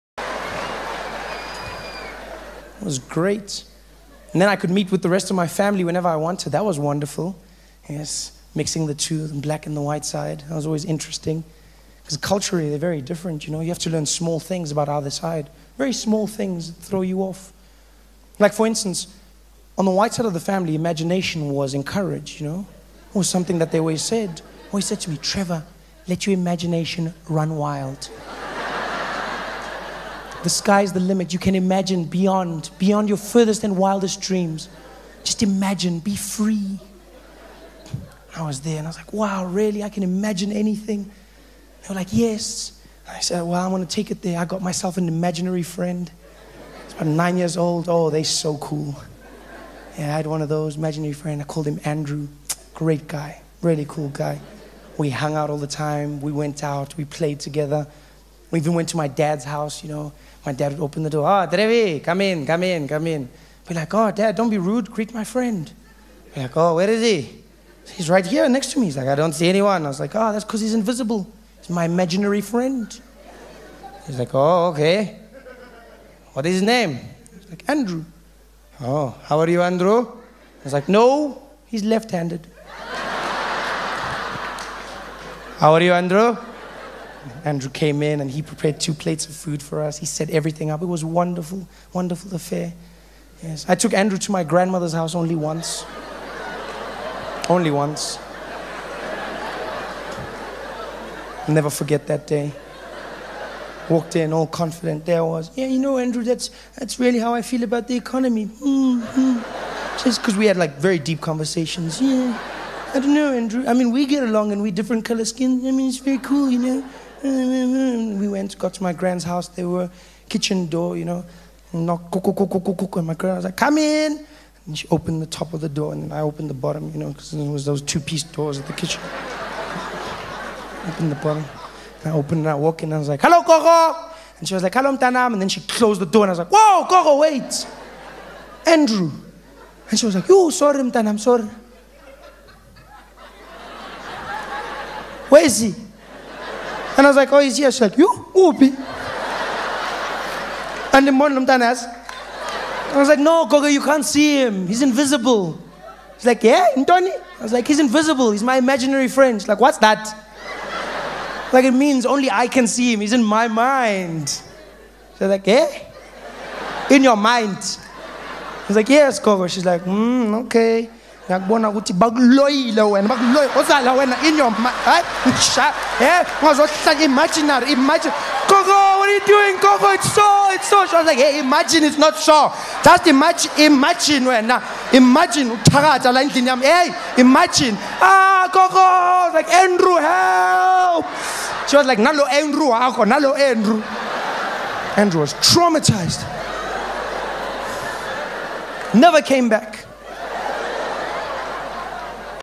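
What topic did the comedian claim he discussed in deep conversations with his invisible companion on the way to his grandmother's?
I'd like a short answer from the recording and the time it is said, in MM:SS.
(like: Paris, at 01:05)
The economy, at 01:47.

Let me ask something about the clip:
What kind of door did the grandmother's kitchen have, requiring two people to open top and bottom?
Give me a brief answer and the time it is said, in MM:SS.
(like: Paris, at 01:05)
Two-piece doors, at 02:07.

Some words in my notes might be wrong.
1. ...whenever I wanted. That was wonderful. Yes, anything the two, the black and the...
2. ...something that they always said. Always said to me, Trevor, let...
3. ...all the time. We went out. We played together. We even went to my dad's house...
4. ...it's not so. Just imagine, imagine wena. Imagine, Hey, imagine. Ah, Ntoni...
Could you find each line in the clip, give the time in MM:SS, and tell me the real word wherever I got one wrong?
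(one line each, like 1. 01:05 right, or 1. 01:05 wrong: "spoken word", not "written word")
1. 00:05 wrong: "mixing", not "anything"
2. 00:23 right
3. 00:55 right
4. 03:01 wrong: "Gogo", not "Ntoni".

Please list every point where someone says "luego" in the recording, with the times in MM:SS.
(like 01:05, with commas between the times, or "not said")
not said.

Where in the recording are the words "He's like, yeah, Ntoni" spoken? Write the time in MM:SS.
02:36.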